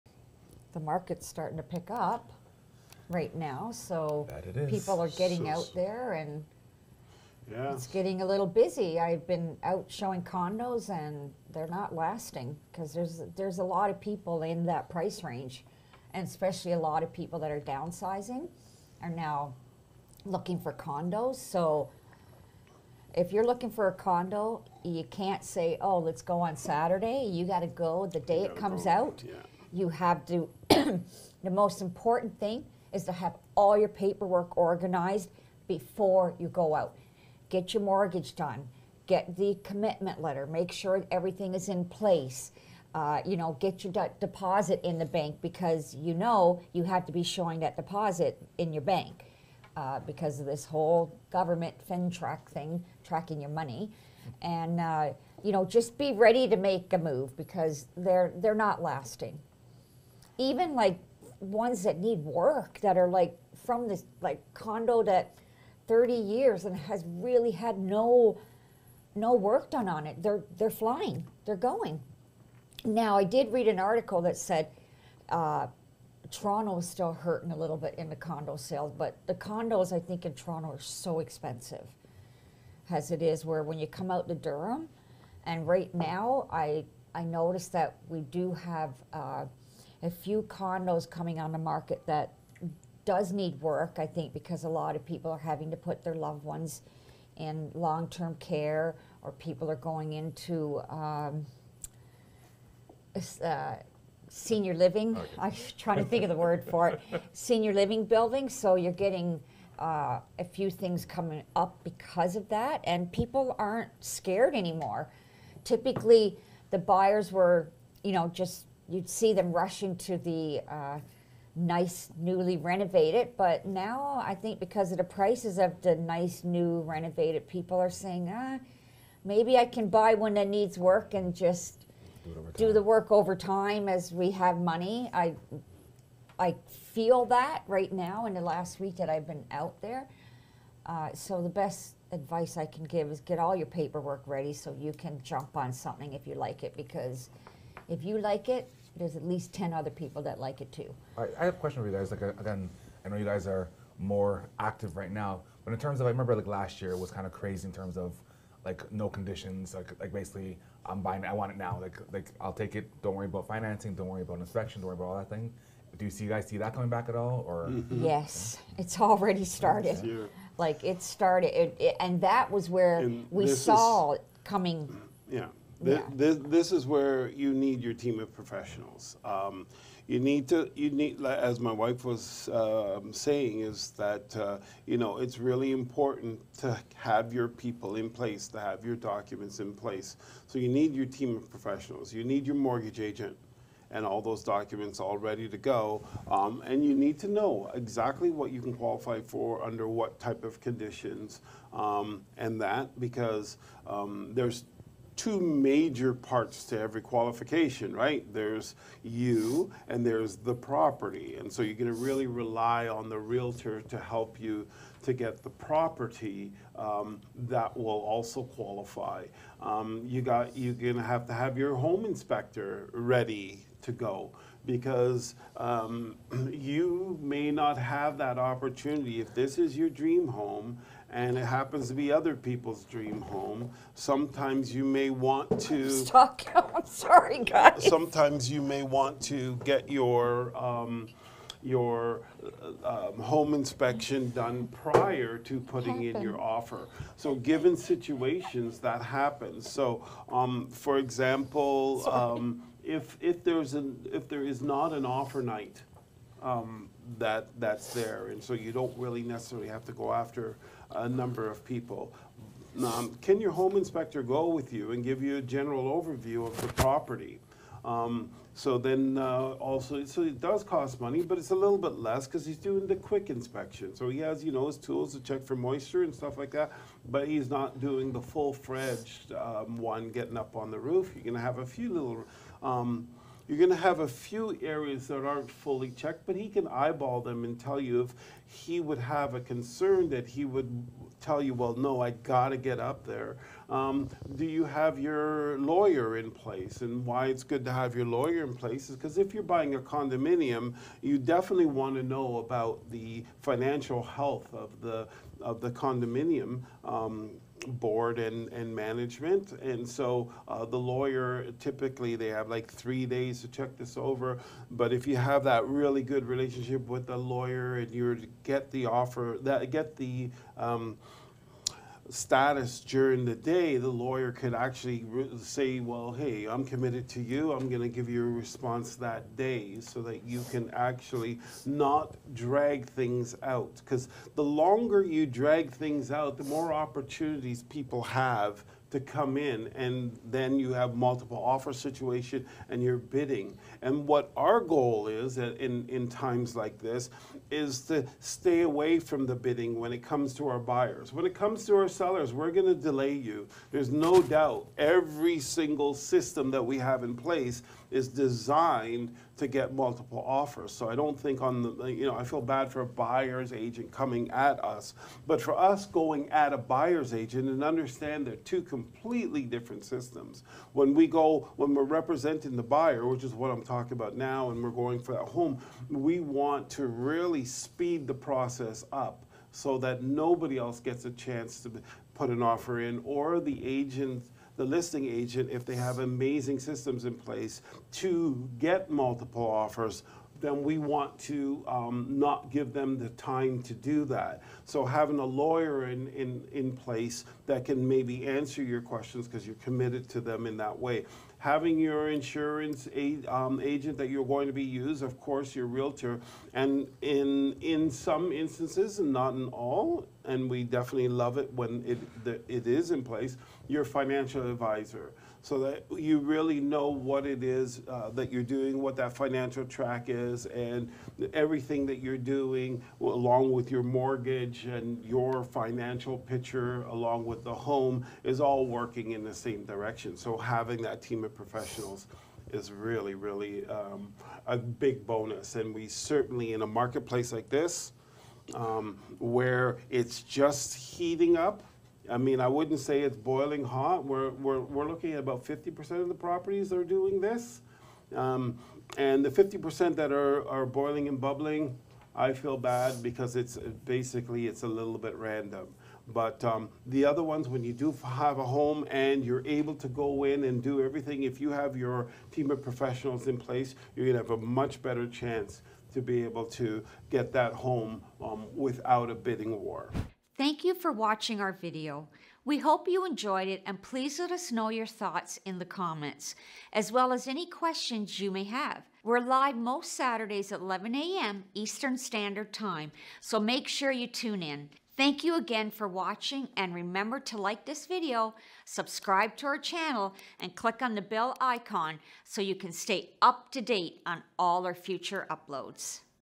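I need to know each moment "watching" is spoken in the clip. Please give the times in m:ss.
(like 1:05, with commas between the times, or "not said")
7:50, 8:05.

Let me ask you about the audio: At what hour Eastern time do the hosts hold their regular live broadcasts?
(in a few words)
11 a.m.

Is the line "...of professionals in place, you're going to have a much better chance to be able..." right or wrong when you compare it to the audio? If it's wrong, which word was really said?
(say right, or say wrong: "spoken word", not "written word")
right.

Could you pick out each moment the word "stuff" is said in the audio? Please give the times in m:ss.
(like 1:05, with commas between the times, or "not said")
4:36.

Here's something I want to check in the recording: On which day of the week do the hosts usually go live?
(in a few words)
Saturday.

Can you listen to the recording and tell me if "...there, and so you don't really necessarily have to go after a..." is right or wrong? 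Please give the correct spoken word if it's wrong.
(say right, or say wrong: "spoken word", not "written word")
right.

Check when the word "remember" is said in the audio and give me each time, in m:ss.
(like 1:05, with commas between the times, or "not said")
2:36, 8:06.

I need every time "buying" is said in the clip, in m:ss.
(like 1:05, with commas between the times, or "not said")
2:41, 4:59.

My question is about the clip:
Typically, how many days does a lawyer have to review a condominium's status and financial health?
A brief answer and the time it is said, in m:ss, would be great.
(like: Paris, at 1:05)
3, at 5:12.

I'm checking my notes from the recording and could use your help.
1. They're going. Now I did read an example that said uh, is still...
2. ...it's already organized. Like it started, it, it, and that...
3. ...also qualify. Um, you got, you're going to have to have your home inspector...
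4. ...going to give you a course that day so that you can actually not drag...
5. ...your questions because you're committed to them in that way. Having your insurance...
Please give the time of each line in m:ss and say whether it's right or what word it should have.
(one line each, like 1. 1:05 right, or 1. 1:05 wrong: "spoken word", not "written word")
1. 1:11 wrong: "article", not "example"
2. 2:48 wrong: "started", not "organized"
3. 3:38 right
4. 5:27 wrong: "response", not "course"
5. 6:38 right.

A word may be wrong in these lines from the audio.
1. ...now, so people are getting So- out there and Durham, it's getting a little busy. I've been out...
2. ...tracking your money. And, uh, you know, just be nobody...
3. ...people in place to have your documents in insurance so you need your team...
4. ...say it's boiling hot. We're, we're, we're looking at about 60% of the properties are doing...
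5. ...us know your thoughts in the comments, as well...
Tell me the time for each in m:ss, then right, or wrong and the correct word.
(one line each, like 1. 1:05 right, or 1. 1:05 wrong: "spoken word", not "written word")
1. 0:03 wrong: "Yeah", not "Durham"
2. 0:53 wrong: "ready", not "nobody"
3. 3:07 wrong: "place", not "insurance"
4. 7:22 wrong: "50", not "60"
5. 7:54 right.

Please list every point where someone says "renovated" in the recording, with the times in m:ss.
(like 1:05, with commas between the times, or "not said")
2:02, 2:06.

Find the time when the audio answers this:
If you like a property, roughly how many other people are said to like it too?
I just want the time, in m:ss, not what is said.
2:29.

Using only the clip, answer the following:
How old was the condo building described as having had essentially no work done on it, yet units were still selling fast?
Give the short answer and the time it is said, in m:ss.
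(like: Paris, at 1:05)
30 years, at 1:05.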